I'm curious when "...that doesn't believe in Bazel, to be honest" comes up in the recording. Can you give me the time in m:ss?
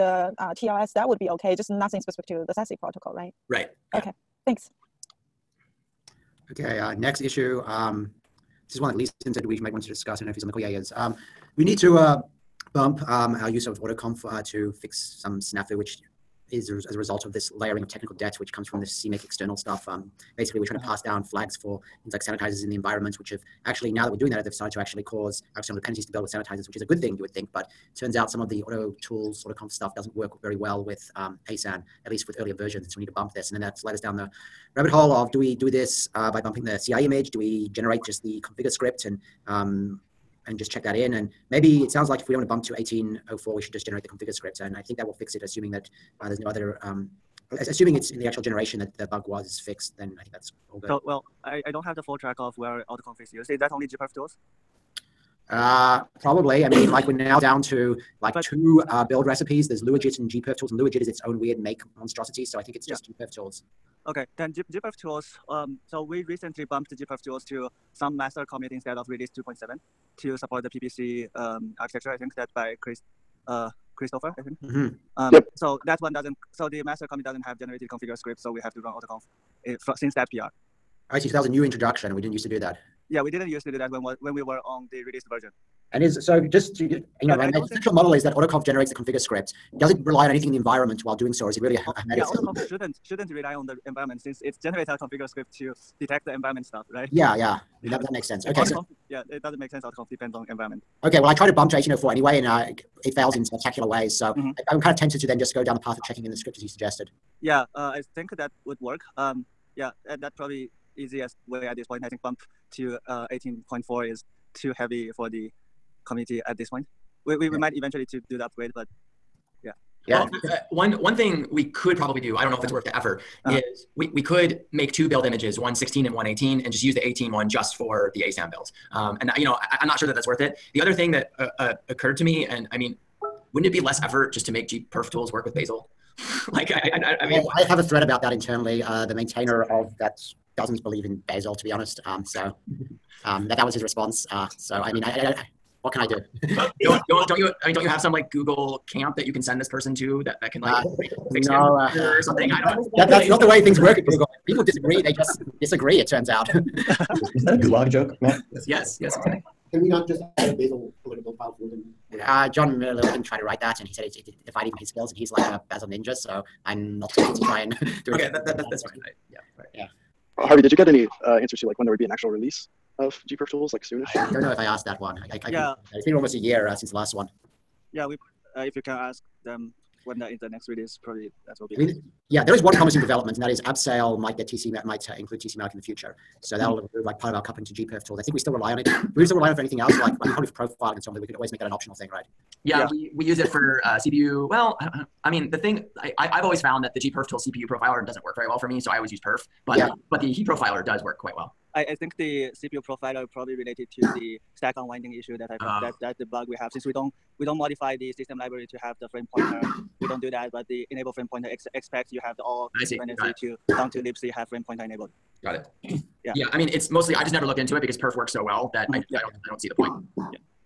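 2:19.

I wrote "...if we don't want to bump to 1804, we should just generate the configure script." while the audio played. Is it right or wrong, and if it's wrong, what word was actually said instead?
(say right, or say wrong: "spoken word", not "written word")
right.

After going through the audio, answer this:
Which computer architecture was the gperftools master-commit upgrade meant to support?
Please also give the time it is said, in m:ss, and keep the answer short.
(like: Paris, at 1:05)
PPC, at 1:10.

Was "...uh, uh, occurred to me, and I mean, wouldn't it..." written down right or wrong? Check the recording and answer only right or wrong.
right.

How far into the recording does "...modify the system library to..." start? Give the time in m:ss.
3:27.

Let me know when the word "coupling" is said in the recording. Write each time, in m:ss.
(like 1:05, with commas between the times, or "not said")
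3:07.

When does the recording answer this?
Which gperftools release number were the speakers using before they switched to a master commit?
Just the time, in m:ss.
1:09.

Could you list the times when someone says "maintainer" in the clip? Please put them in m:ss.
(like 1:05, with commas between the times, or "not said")
2:19.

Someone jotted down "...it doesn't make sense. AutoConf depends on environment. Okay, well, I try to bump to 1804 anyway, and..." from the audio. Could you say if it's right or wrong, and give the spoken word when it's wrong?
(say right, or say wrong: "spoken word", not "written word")
right.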